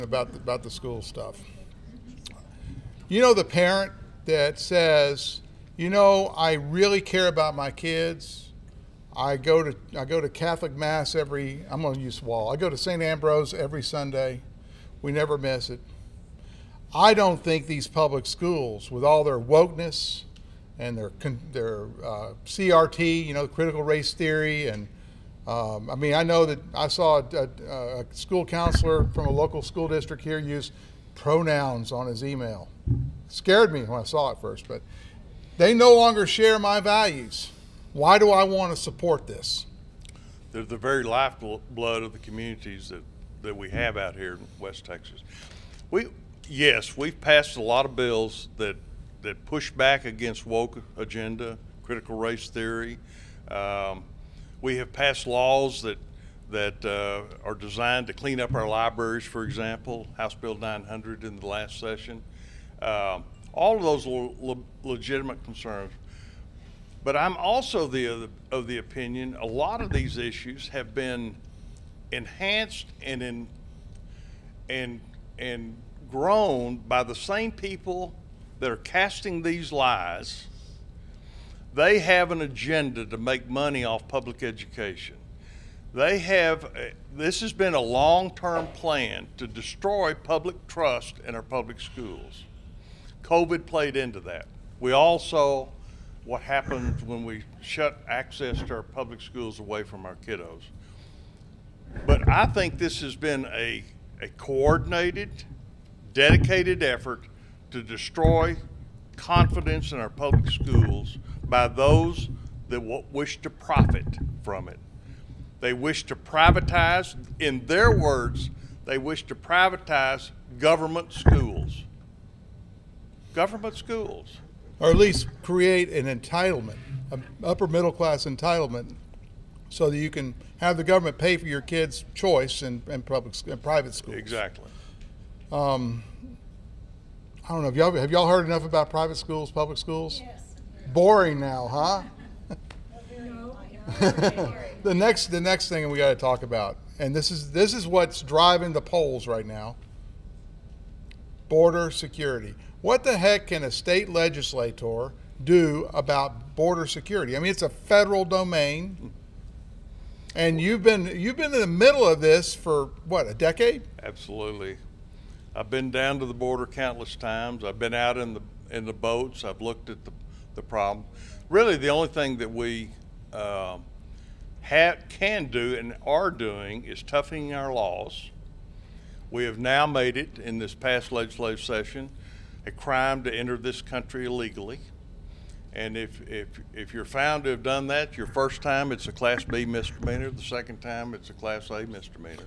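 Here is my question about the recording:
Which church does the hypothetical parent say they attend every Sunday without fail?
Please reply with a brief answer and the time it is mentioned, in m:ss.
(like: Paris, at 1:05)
St. Ambrose, at 0:12.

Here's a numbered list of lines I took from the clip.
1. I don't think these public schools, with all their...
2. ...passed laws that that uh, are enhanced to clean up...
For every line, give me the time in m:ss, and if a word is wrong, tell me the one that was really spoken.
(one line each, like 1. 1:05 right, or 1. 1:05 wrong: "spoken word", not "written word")
1. 0:16 right
2. 0:54 wrong: "designed", not "enhanced".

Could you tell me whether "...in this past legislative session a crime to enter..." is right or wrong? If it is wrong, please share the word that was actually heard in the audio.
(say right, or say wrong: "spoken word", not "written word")
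right.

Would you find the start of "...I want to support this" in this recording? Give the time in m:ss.
0:38.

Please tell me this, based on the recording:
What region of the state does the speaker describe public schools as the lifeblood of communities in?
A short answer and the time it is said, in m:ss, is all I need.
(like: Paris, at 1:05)
West Texas, at 0:44.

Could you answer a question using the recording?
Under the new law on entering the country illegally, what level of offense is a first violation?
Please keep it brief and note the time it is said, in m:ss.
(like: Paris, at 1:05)
Class B misdemeanor, at 3:09.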